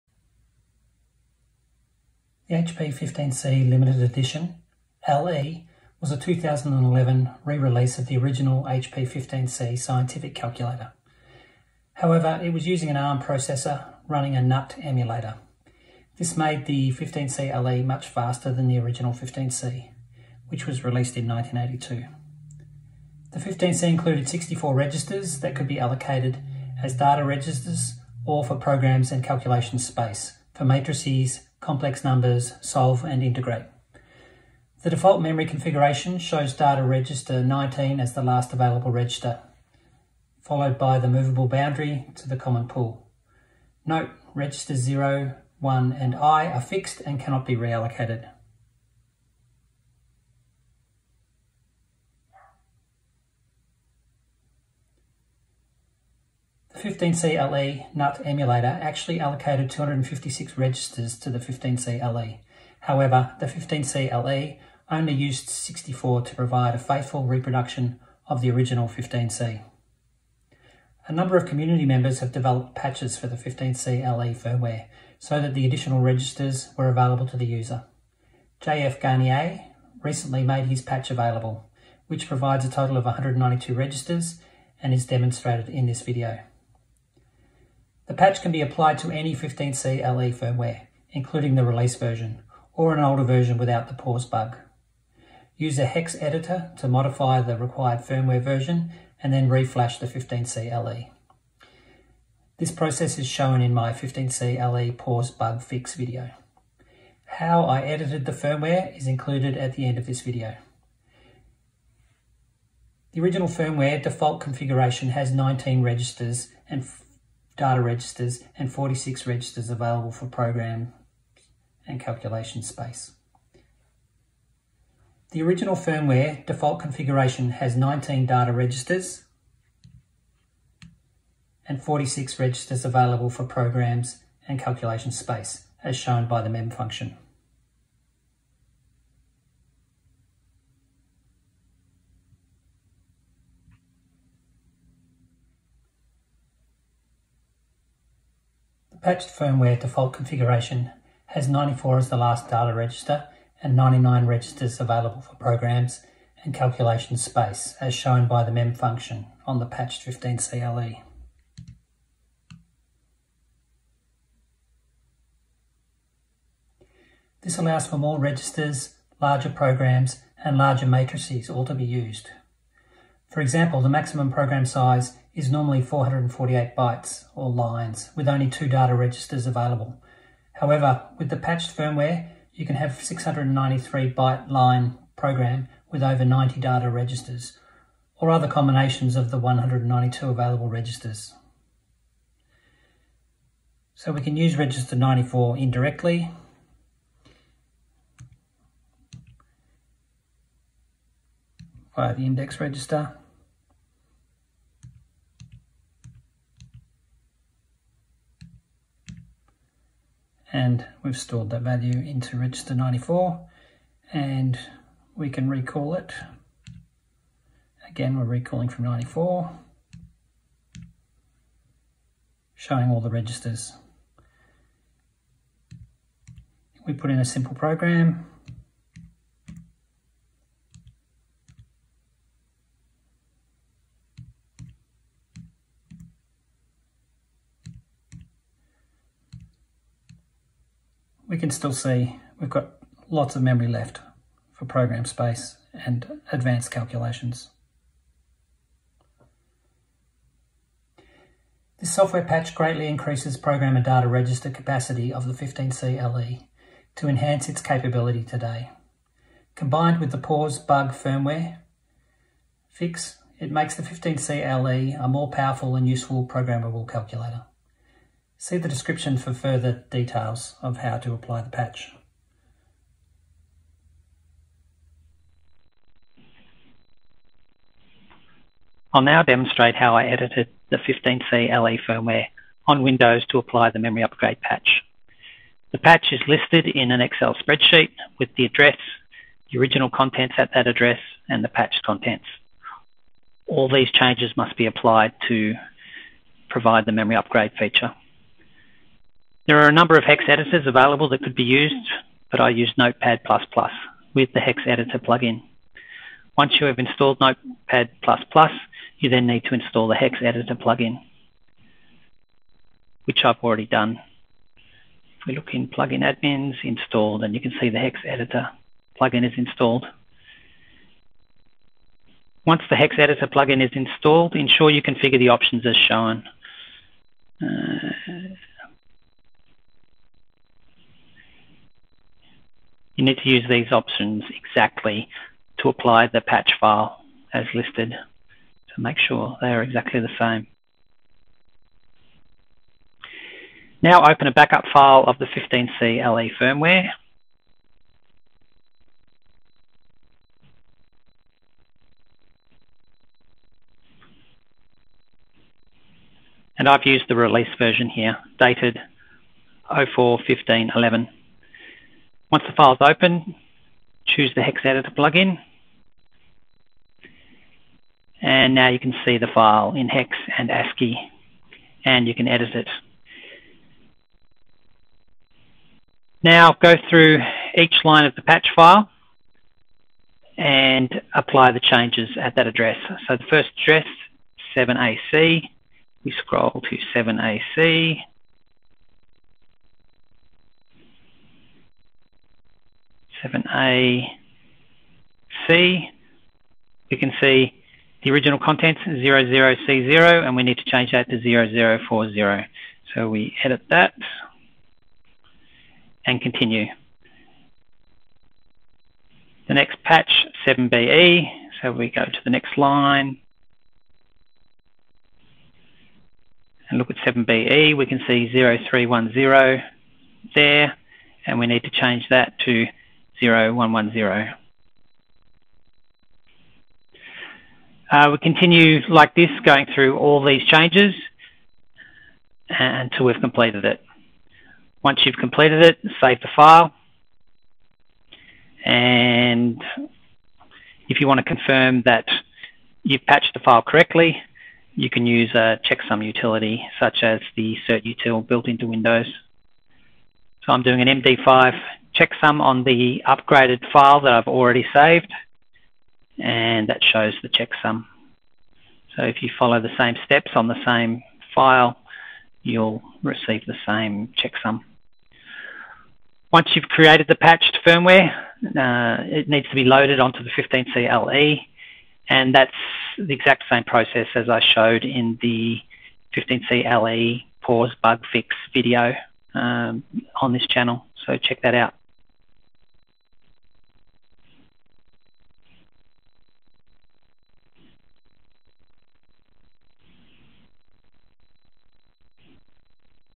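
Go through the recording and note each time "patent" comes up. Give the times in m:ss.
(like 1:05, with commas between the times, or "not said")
not said.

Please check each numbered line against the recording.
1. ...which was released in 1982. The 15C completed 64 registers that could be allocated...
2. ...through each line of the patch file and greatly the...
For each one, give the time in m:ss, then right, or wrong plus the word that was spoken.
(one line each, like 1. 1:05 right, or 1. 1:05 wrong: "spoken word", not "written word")
1. 0:20 wrong: "included", not "completed"
2. 6:16 wrong: "apply", not "greatly".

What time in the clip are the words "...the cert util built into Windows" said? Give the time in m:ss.
7:27.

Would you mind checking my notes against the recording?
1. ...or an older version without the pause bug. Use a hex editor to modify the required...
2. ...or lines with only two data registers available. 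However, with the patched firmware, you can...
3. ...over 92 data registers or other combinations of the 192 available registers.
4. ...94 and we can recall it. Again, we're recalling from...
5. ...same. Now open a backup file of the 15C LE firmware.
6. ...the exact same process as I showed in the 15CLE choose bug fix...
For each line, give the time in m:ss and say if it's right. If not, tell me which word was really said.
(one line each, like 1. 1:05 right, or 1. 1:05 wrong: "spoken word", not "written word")
1. 1:32 right
2. 2:57 right
3. 3:06 wrong: "90", not "92"
4. 3:32 right
5. 5:40 right
6. 7:52 wrong: "pause", not "choose".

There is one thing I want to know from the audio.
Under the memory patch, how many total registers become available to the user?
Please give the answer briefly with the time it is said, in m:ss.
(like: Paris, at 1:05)
192, at 1:23.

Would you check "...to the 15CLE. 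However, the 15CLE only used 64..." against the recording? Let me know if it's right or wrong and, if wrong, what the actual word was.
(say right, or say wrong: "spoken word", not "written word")
right.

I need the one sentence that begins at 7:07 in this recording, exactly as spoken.
Uh, we continue like this, going through all these changes until we've completed it.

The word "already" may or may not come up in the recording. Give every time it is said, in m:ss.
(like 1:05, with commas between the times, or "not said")
5:13, 7:34.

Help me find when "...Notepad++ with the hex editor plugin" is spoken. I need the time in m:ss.
5:02.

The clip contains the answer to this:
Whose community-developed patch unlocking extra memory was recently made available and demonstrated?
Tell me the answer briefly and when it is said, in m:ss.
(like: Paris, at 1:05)
JF Garnier, at 1:18.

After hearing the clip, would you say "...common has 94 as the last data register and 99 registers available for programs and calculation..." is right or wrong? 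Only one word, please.
wrong.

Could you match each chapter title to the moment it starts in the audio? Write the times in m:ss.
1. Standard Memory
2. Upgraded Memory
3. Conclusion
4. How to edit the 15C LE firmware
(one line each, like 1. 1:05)
1. 2:02
2. 2:24
3. 4:09
4. 4:35.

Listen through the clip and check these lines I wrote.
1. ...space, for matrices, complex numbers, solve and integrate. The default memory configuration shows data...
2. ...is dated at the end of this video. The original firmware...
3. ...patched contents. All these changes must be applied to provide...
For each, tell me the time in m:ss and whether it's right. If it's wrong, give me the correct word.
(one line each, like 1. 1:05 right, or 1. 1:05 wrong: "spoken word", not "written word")
1. 0:29 right
2. 1:48 wrong: "included", not "dated"
3. 4:51 right.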